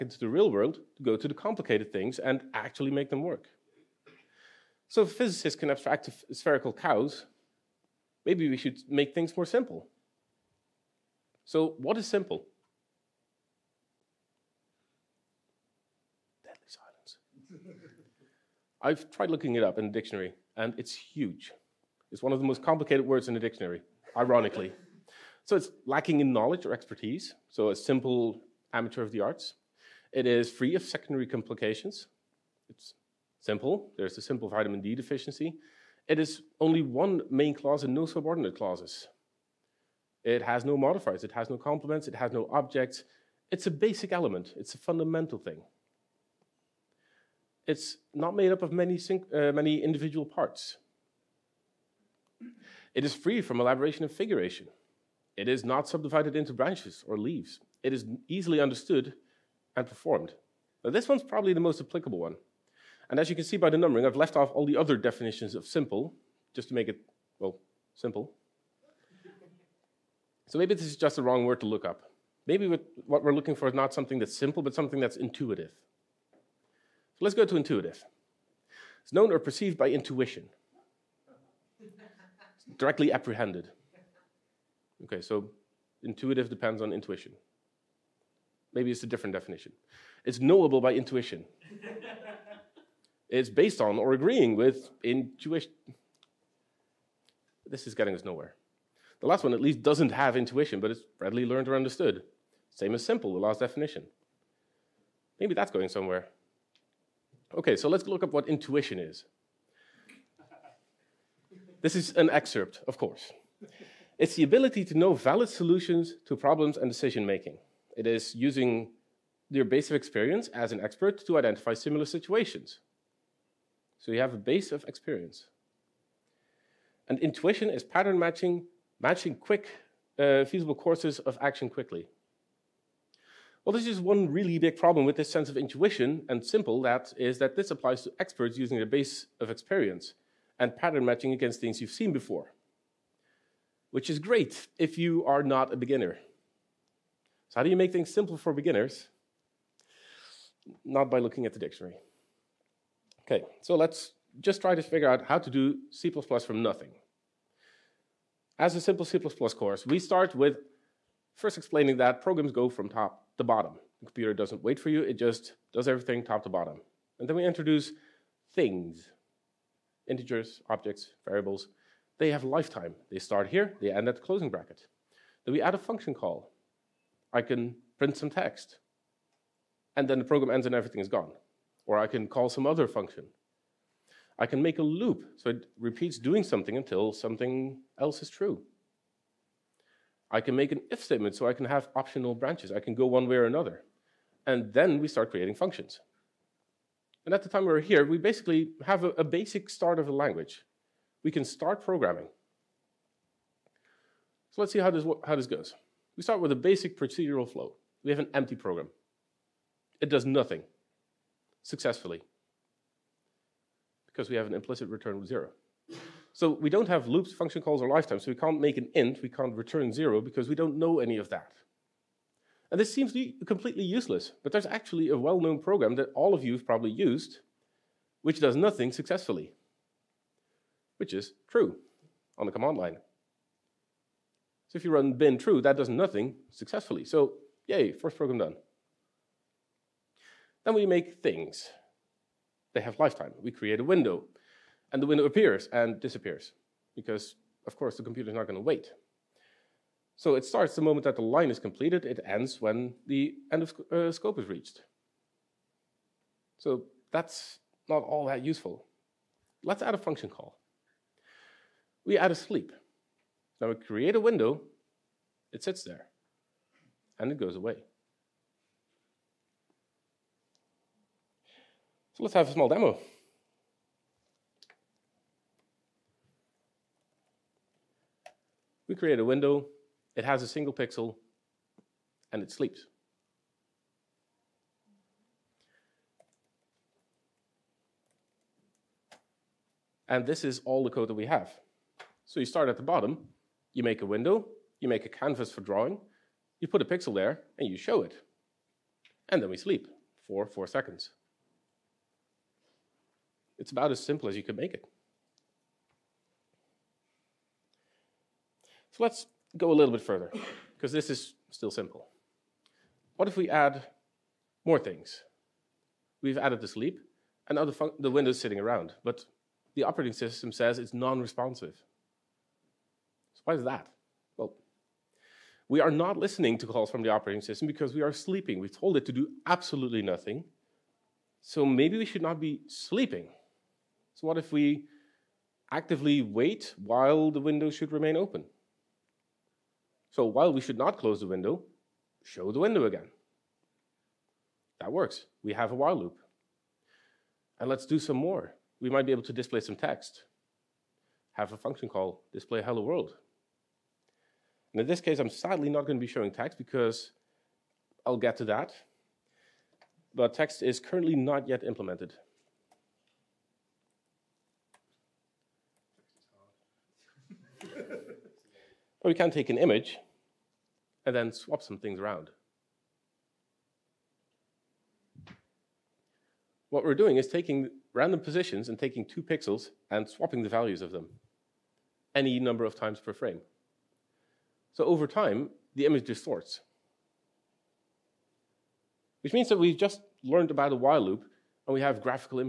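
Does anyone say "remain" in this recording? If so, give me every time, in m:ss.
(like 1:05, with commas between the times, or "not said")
5:37.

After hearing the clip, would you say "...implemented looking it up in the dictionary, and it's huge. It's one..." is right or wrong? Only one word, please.
wrong.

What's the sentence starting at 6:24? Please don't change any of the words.
So over time, the image distorts.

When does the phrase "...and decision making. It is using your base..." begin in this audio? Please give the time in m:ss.
1:56.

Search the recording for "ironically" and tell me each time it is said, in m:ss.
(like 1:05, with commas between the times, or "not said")
0:24.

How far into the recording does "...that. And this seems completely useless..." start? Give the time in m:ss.
3:41.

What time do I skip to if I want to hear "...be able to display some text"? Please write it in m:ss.
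5:49.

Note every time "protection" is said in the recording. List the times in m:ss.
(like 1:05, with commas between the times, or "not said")
not said.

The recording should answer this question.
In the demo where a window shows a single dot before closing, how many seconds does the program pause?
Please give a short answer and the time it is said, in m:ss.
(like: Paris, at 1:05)
4, at 5:00.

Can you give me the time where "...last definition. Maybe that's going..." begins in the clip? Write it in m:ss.
1:43.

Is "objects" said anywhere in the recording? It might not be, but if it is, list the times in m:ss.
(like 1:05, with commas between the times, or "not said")
0:42, 2:50.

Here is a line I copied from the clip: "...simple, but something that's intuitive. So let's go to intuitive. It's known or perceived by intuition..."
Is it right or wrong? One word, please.
right.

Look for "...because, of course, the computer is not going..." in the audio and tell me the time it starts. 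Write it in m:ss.
4:06.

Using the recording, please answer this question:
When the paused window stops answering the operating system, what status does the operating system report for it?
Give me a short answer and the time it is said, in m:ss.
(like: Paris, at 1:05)
non-responsive, at 5:20.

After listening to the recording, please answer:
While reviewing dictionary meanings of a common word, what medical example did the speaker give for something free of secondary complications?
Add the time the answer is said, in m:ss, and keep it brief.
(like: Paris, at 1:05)
vitamin D deficiency, at 0:34.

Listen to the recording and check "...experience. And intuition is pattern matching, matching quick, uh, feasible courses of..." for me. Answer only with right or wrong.
right.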